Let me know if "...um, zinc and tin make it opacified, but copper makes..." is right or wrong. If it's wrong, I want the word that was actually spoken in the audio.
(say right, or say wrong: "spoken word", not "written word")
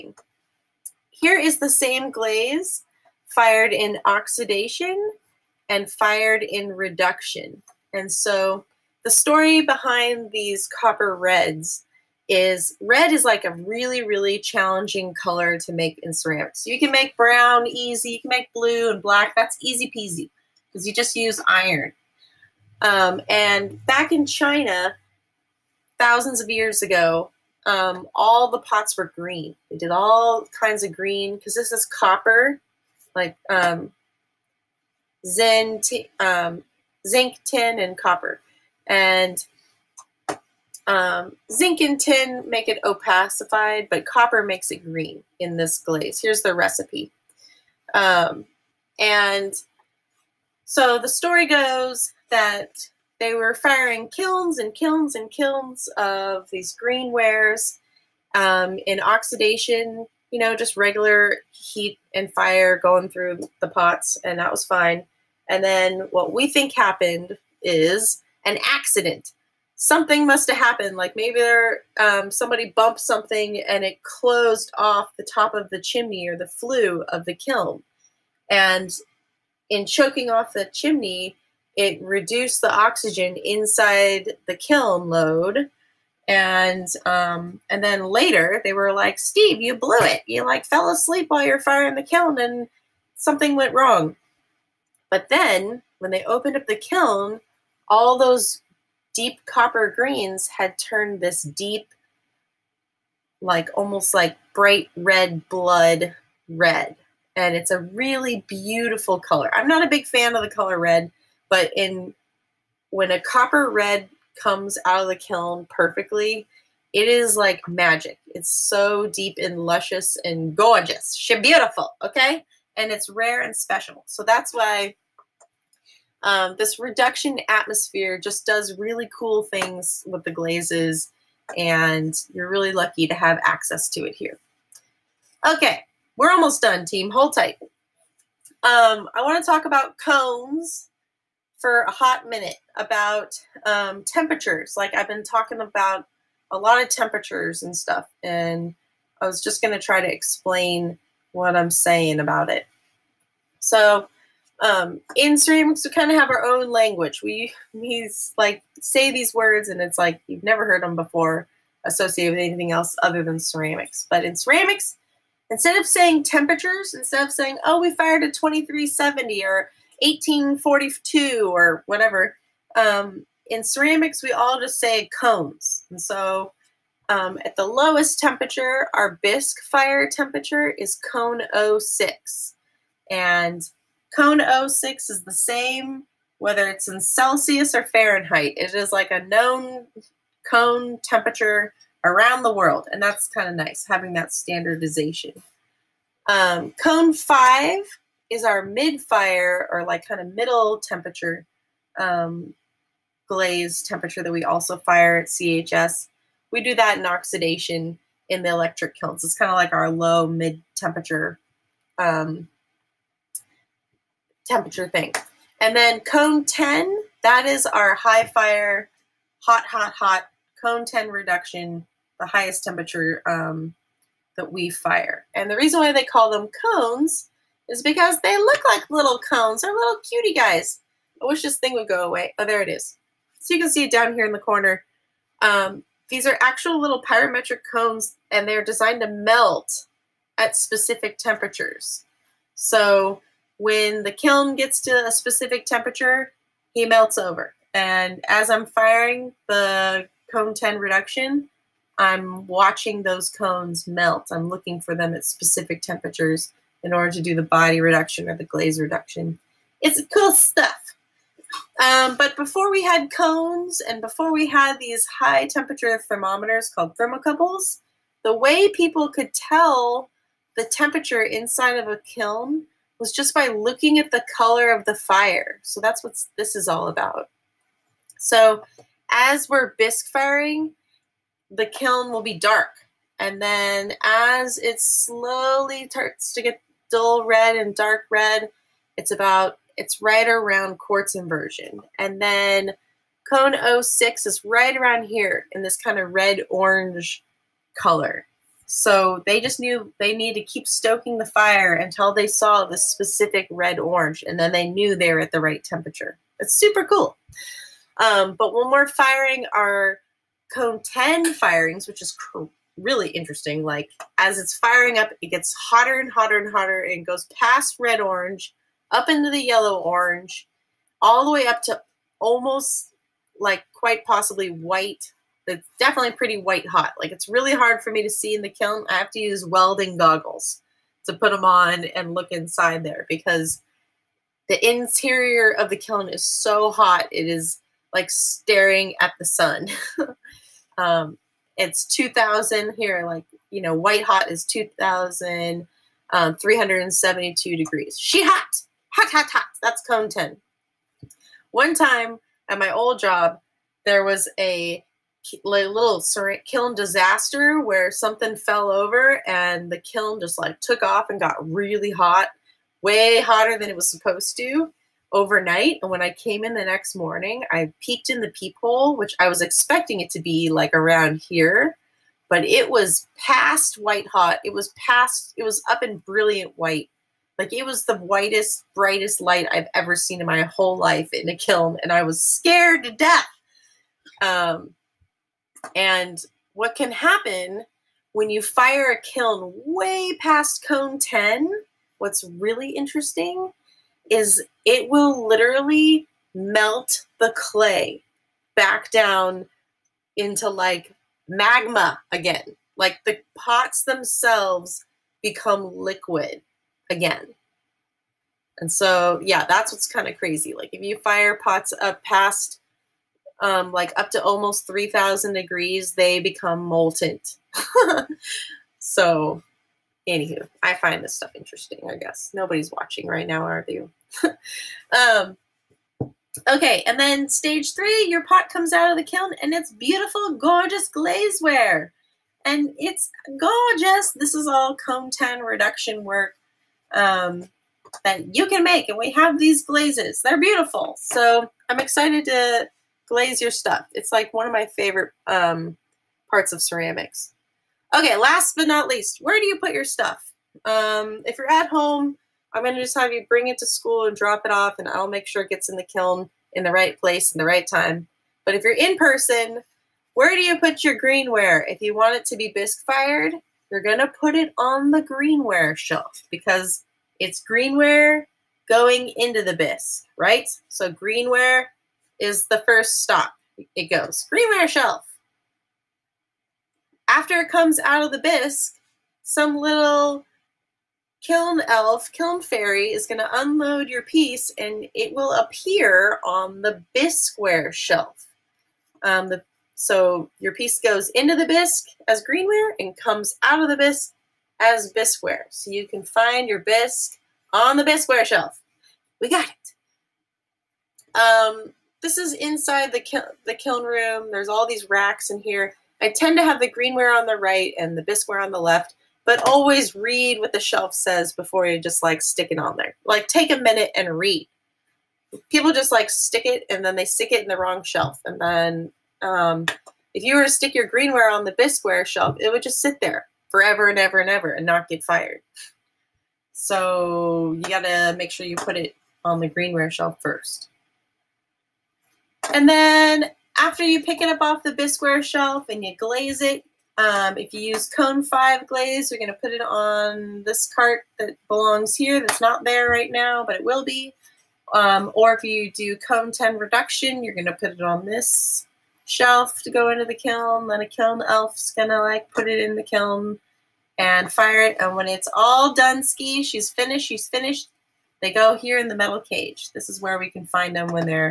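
right.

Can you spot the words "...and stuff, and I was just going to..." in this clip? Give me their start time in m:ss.
2:27.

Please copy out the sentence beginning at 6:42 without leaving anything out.
Like the pots themselves become liquid again.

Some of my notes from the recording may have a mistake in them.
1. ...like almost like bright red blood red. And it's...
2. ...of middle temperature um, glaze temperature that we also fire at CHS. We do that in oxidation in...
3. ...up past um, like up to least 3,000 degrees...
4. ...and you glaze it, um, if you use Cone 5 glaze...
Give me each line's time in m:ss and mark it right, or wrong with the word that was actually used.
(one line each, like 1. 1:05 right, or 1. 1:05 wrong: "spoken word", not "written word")
1. 1:43 right
2. 3:20 right
3. 6:51 wrong: "almost", not "least"
4. 8:55 right.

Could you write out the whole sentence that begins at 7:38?
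But if you're in person, where do you put your greenware?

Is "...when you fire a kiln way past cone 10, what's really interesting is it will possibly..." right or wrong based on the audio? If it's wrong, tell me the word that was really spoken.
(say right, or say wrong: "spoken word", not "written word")
wrong: "literally", not "possibly".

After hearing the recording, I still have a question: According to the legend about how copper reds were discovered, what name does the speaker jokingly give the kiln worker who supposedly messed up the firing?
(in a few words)
Steve.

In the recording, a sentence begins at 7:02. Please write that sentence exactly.
Nobody's watching right now, are you?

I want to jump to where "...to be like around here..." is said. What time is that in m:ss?
6:10.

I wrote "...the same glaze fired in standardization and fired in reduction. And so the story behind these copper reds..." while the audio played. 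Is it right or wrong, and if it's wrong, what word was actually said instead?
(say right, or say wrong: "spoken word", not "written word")
wrong: "oxidation", not "standardization".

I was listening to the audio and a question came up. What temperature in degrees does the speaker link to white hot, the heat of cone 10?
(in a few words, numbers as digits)
2372.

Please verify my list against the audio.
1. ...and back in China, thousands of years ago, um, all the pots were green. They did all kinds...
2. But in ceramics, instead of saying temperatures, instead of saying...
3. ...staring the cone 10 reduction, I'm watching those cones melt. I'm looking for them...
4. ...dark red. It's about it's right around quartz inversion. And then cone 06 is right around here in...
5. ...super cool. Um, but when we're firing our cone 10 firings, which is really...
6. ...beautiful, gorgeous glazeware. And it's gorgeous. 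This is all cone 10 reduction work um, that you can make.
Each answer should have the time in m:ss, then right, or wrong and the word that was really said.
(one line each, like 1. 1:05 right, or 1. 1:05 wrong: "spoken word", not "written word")
1. 0:23 right
2. 2:44 right
3. 4:08 wrong: "firing", not "staring"
4. 4:47 right
5. 5:06 right
6. 7:09 right.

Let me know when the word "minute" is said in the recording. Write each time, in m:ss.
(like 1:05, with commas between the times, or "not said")
2:22, 8:33.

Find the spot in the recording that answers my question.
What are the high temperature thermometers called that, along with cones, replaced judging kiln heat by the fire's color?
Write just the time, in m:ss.
4:26.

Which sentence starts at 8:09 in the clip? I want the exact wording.
Um, the, so your piece goes into the bisque as greenware and comes out of the bisque as bisqueware.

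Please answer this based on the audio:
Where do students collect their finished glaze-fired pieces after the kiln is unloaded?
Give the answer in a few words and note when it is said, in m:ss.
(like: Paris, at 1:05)
the metal cage, at 9:18.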